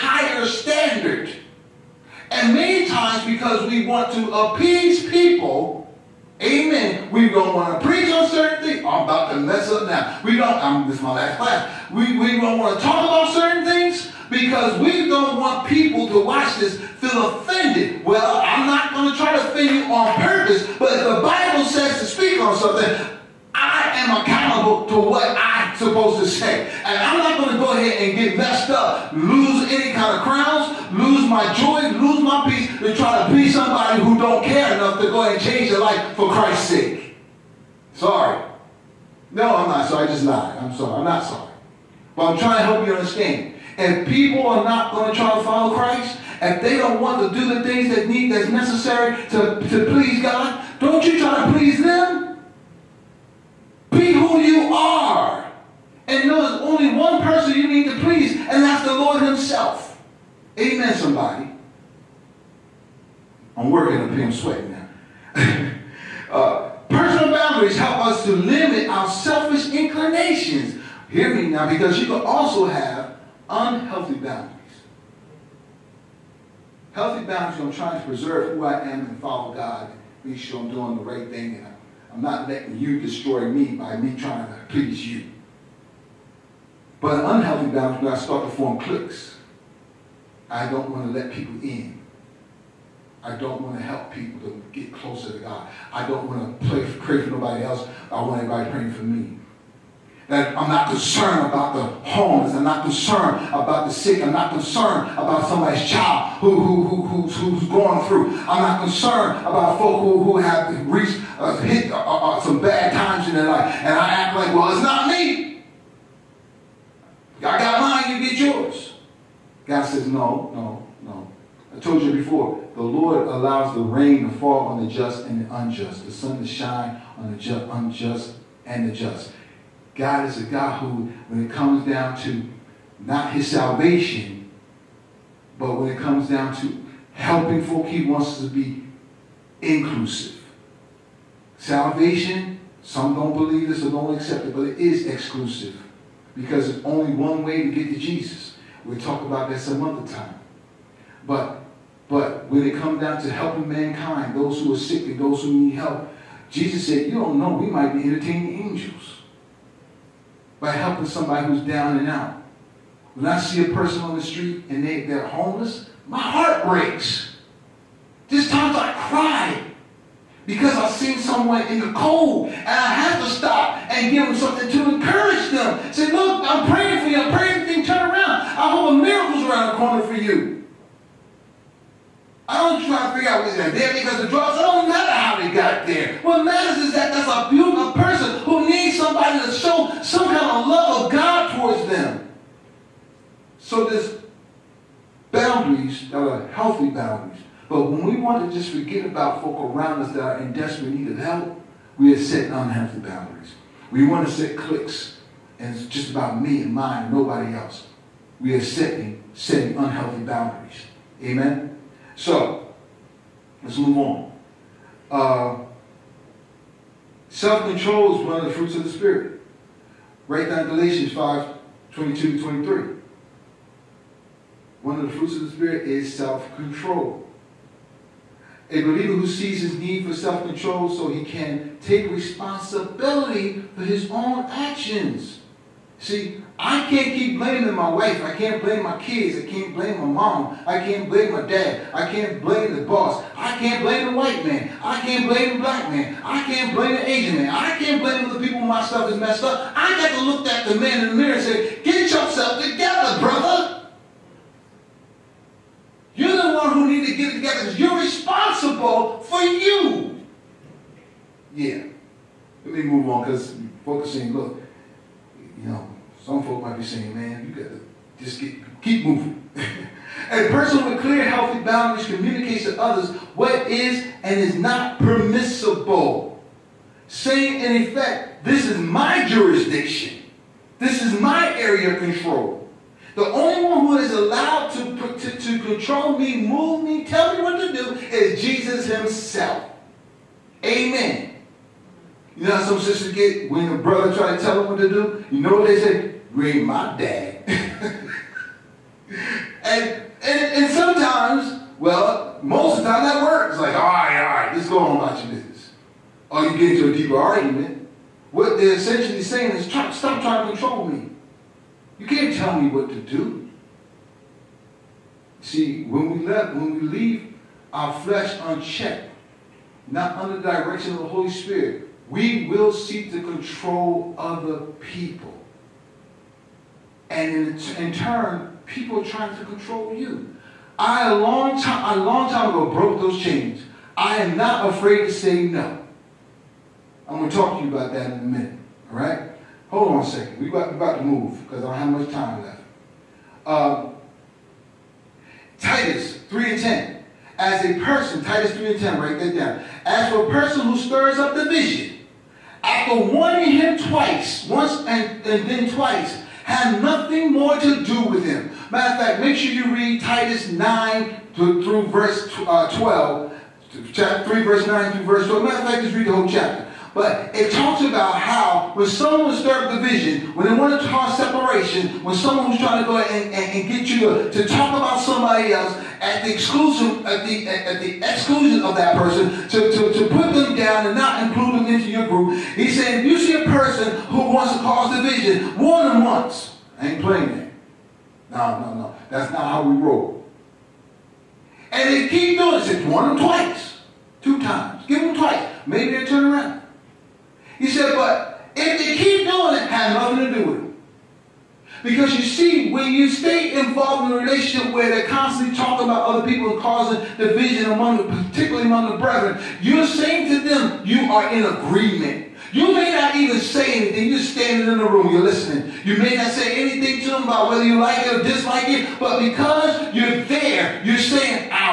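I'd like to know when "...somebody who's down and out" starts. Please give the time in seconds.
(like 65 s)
161 s.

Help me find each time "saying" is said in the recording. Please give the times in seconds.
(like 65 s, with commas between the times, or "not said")
266 s, 277 s, 309 s, 409 s, 420 s.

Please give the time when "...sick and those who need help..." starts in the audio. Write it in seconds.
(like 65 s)
154 s.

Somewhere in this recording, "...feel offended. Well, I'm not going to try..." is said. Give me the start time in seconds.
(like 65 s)
16 s.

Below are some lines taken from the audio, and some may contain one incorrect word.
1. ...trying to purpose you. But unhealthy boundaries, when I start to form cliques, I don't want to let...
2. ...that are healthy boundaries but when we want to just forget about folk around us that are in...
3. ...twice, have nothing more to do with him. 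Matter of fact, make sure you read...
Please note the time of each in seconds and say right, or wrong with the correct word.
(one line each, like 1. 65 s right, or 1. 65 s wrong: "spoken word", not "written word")
1. 84 s wrong: "please", not "purpose"
2. 196 s right
3. 355 s right.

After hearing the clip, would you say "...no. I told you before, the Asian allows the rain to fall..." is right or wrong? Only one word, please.
wrong.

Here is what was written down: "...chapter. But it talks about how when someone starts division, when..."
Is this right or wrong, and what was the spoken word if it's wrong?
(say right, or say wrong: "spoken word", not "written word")
right.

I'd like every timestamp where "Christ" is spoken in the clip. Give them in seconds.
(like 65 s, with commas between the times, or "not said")
36 s, 45 s.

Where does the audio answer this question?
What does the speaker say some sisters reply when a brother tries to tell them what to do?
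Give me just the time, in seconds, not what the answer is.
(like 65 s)
296 s.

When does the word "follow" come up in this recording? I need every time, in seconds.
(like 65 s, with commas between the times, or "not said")
45 s, 79 s.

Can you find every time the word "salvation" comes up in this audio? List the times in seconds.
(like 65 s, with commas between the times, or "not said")
133 s, 141 s.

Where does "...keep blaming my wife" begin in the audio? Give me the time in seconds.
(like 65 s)
237 s.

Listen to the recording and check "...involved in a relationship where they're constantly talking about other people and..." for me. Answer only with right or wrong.
right.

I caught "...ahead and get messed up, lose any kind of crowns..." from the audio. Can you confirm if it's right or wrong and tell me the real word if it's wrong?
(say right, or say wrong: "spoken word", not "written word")
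right.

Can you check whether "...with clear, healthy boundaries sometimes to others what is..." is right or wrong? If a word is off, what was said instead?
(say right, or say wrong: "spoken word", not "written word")
wrong: "communicates", not "sometimes".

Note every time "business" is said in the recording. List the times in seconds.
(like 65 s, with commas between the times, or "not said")
305 s.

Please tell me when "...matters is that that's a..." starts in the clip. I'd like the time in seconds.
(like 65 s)
186 s.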